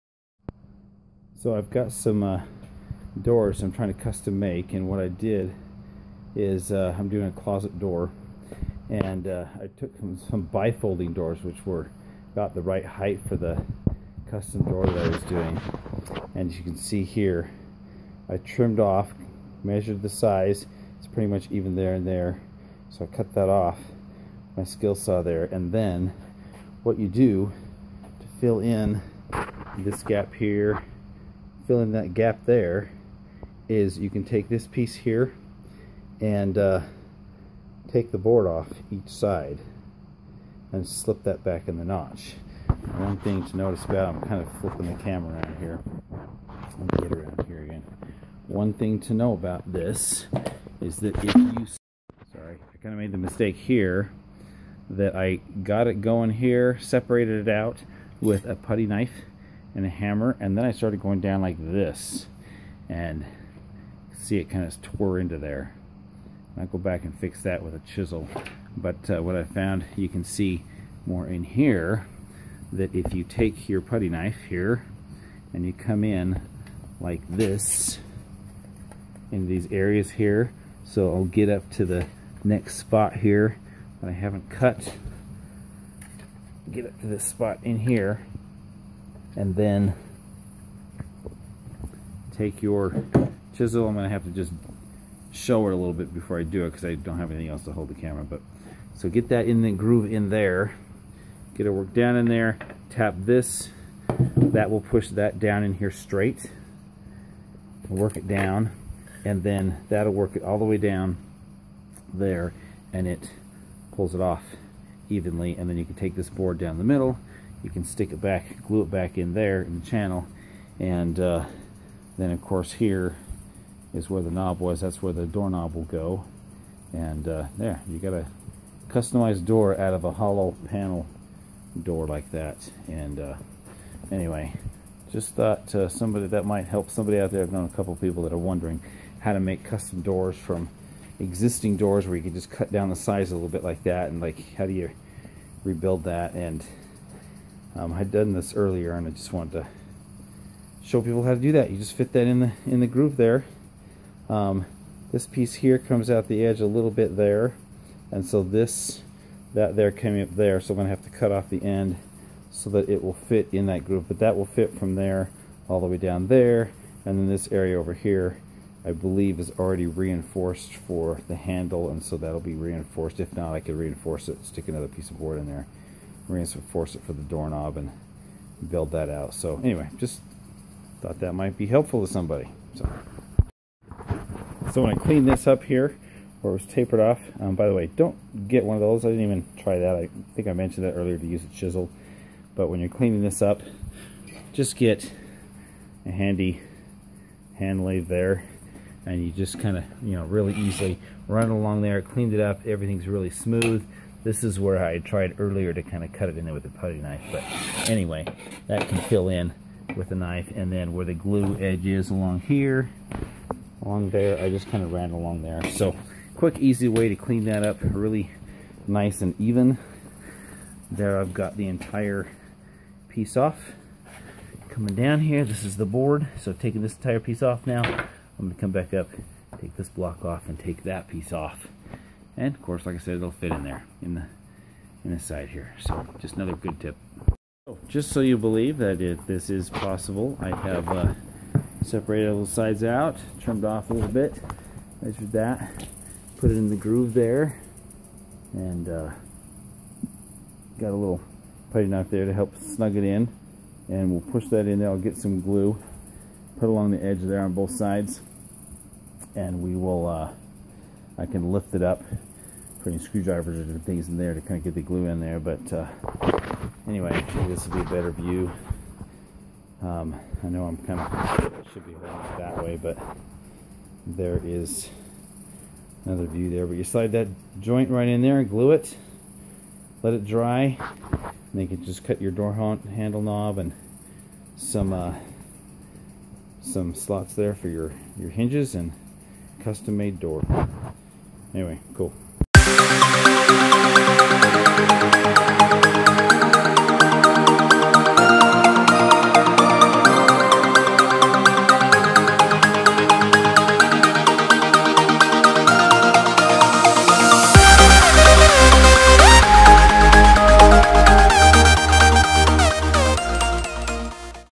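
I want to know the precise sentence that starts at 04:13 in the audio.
And we'll push that in there.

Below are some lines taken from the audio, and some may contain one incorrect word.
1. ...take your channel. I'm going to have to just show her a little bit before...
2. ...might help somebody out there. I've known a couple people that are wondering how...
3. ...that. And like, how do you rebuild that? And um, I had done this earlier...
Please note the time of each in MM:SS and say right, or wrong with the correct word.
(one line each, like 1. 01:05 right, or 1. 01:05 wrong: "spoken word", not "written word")
1. 01:32 wrong: "chisel", not "channel"
2. 02:16 right
3. 02:23 right.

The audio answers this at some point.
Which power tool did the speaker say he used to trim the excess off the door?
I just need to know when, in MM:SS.
00:24.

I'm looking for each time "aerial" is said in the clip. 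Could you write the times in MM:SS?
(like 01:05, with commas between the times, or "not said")
not said.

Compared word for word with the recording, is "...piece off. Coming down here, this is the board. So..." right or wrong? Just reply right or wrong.
right.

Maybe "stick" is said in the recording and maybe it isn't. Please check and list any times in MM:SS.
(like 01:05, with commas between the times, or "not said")
01:57, 02:54.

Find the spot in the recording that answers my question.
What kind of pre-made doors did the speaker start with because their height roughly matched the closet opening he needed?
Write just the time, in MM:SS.
00:10.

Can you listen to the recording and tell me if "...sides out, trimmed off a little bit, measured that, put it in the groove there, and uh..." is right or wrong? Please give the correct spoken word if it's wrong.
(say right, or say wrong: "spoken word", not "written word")
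right.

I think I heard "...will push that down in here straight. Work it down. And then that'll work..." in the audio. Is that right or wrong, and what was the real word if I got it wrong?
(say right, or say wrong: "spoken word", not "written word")
right.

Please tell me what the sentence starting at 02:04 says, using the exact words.
That's where the doorknob will go.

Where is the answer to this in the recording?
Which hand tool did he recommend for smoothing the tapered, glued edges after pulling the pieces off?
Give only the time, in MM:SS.
03:17.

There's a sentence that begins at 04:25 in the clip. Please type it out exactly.
But uh, anyway, this will be a better view.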